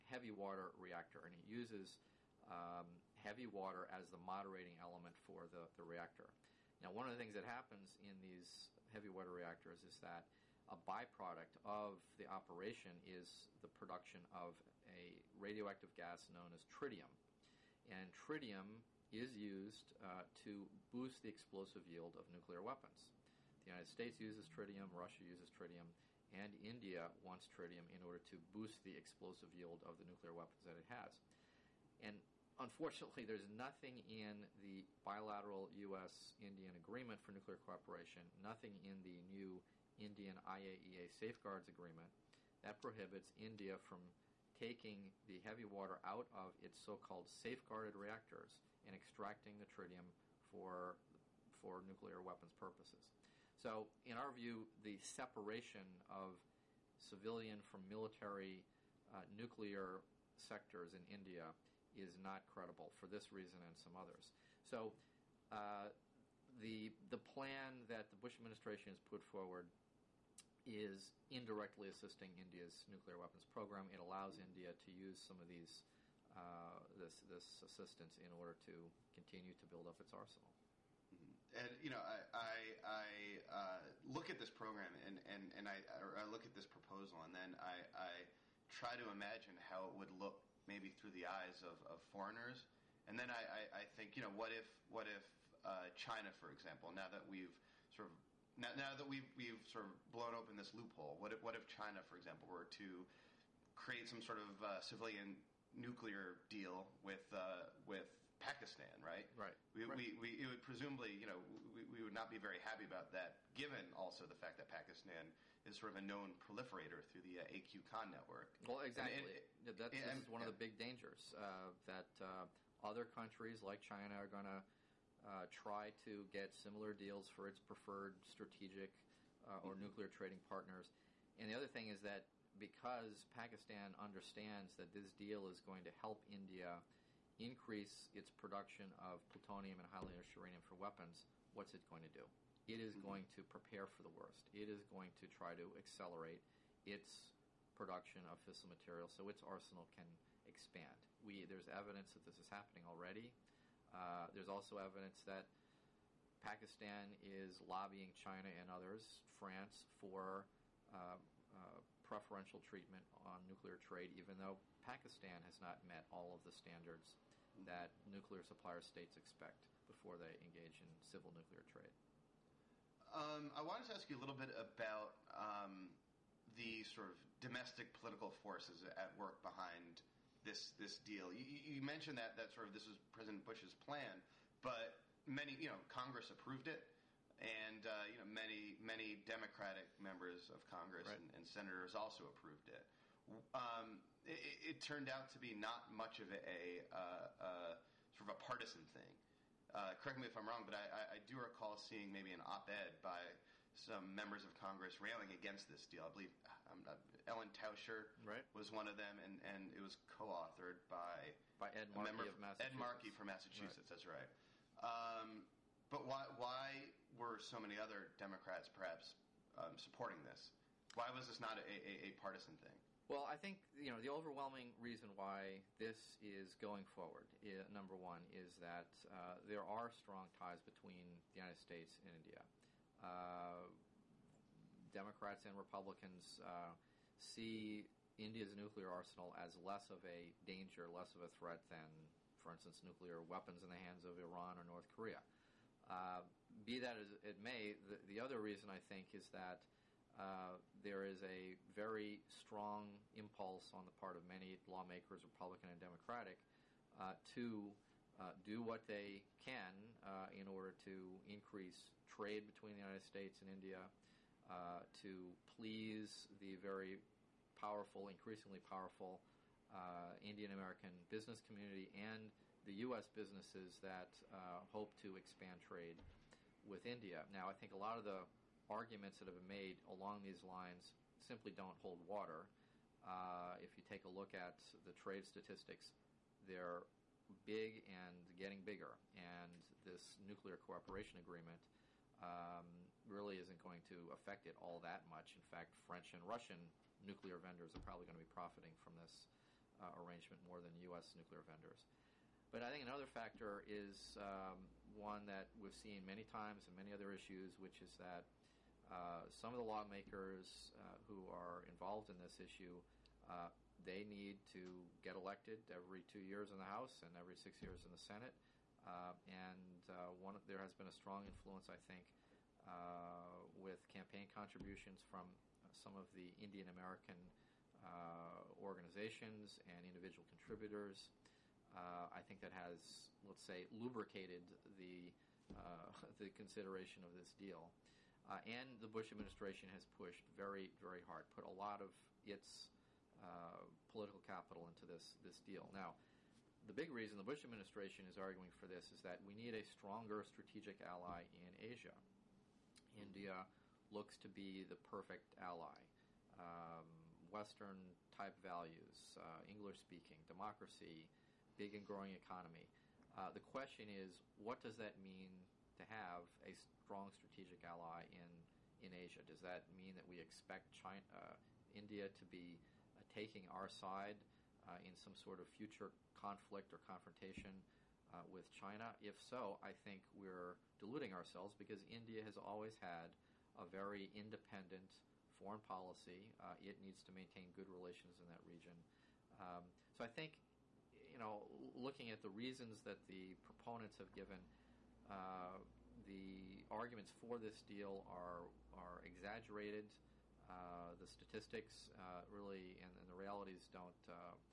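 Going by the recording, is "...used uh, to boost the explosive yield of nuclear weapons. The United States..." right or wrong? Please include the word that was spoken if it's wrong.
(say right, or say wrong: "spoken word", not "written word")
right.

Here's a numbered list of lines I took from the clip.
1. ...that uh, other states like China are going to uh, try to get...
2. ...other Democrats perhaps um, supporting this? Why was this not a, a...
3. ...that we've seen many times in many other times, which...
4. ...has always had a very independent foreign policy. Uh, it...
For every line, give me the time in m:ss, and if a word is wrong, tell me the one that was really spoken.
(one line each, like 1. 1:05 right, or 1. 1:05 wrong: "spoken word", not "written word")
1. 2:01 wrong: "countries", not "states"
2. 3:37 right
3. 5:05 wrong: "issues", not "times"
4. 6:22 right.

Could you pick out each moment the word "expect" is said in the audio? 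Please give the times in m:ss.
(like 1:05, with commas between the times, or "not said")
2:49, 6:10.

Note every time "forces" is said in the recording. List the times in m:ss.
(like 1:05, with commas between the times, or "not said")
2:58.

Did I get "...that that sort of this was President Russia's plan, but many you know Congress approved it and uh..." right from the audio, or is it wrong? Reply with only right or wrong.
wrong.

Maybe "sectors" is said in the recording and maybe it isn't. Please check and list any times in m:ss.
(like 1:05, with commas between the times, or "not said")
1:00.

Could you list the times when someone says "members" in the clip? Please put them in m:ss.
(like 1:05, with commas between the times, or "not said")
3:09, 3:24.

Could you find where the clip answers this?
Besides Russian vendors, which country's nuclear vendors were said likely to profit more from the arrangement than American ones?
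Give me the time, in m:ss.
4:55.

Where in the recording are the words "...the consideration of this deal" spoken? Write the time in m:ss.
5:36.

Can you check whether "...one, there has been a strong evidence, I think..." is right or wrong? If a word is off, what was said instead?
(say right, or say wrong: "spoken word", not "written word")
wrong: "influence", not "evidence".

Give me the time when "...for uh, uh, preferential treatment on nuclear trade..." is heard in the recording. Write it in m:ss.
2:39.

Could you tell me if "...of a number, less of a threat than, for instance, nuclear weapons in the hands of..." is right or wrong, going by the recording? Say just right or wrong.
wrong.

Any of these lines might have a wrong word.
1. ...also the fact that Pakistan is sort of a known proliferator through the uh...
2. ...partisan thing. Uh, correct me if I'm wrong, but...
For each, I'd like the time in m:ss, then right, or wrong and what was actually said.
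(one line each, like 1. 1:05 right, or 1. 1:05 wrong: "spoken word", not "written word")
1. 1:53 right
2. 3:18 right.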